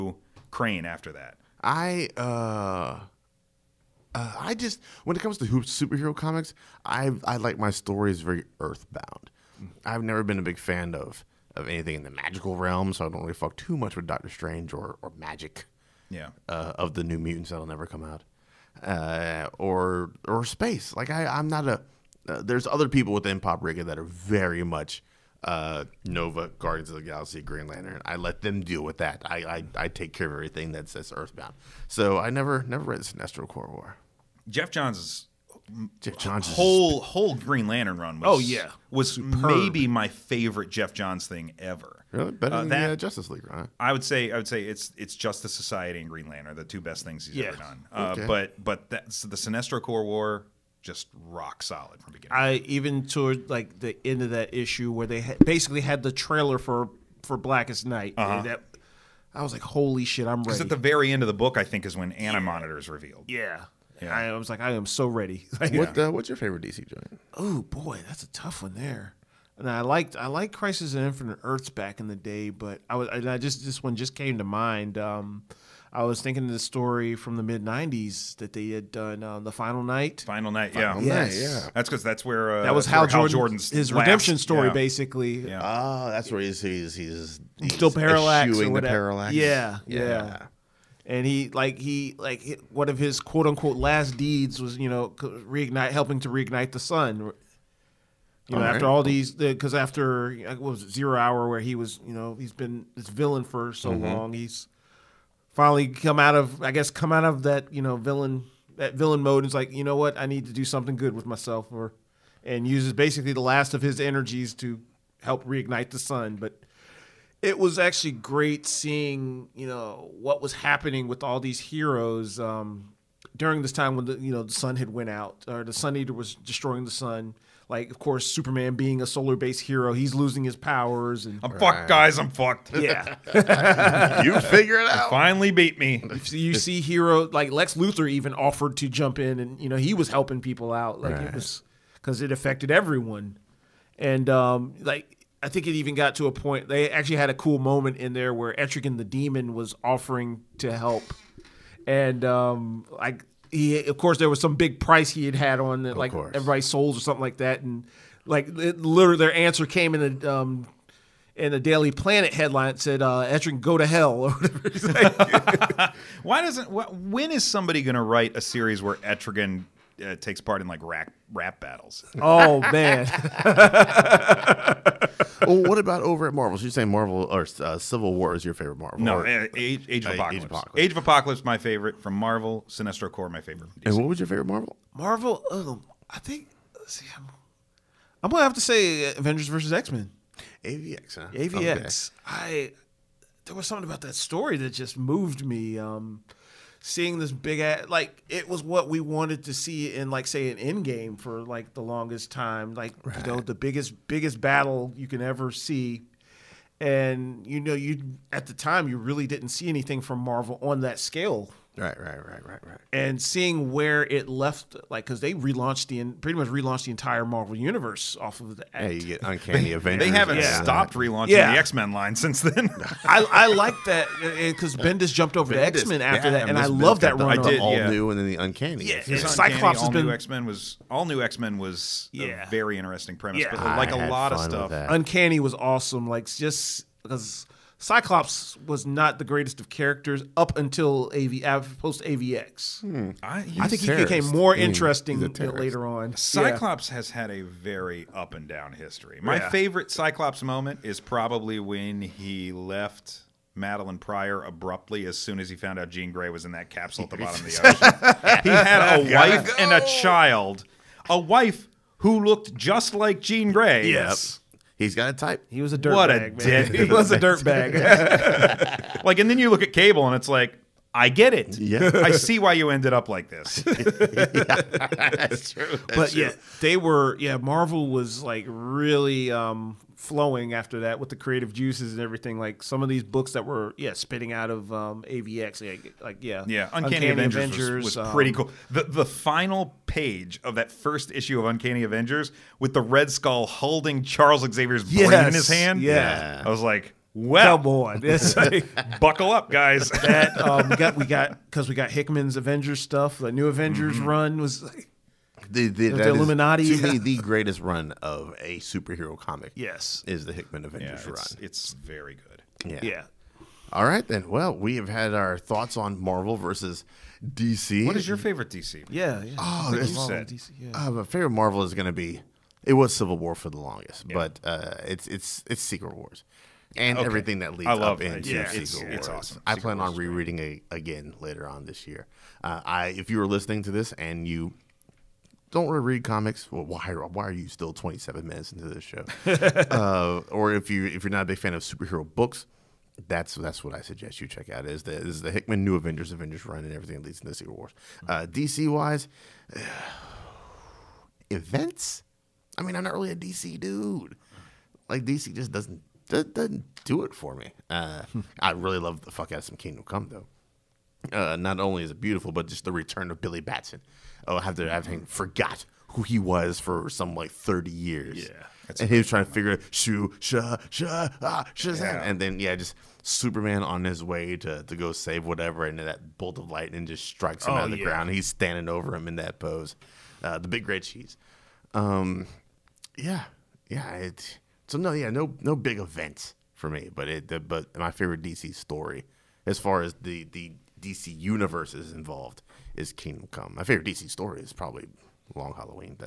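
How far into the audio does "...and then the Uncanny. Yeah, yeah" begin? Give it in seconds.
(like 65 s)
228 s.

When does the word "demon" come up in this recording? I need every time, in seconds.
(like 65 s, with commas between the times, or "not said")
149 s.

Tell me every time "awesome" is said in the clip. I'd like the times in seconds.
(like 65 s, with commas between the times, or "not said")
235 s, 329 s.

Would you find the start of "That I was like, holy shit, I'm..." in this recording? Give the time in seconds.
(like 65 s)
58 s.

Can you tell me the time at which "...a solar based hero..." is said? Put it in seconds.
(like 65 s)
129 s.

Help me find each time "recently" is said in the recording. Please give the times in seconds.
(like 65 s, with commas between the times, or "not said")
not said.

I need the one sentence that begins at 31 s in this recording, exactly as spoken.
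So I never never read Sinestro Corps War.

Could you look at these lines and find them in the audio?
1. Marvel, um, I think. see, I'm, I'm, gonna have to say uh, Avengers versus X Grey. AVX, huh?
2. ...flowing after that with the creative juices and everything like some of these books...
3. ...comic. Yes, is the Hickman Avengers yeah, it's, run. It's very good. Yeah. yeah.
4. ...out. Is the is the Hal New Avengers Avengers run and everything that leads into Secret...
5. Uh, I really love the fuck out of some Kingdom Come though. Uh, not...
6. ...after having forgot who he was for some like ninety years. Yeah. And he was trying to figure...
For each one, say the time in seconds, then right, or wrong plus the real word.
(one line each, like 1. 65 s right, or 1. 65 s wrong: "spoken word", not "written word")
1. 184 s wrong: "Men", not "Grey"
2. 279 s right
3. 309 s right
4. 344 s wrong: "Hickman", not "Hal"
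5. 357 s right
6. 364 s wrong: "thirty", not "ninety".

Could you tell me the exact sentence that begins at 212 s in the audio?
And seeing where it left, like, because they relaunched the pretty much relaunched the entire Marvel universe off of the.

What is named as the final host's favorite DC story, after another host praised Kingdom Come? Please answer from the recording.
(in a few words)
Long Halloween.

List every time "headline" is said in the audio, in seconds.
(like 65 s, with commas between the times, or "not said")
162 s.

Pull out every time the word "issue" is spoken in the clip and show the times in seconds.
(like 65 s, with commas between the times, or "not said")
54 s, 291 s.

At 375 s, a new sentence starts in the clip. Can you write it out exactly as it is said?
And that bolt of lightning just strikes him oh, out of the yeah.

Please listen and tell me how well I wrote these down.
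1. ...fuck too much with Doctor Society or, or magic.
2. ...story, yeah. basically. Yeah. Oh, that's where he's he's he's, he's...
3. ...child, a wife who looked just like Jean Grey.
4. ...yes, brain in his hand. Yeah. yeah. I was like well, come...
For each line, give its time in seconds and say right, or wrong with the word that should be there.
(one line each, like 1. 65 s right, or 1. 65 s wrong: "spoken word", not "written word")
1. 13 s wrong: "Strange", not "Society"
2. 84 s right
3. 259 s right
4. 294 s right.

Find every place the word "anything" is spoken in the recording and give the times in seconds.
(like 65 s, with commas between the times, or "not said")
11 s, 209 s.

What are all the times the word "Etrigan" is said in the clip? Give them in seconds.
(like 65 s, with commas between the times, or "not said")
148 s, 163 s, 168 s.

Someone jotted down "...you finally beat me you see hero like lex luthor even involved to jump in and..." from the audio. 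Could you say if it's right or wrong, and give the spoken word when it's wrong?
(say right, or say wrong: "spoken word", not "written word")
wrong: "offered", not "involved".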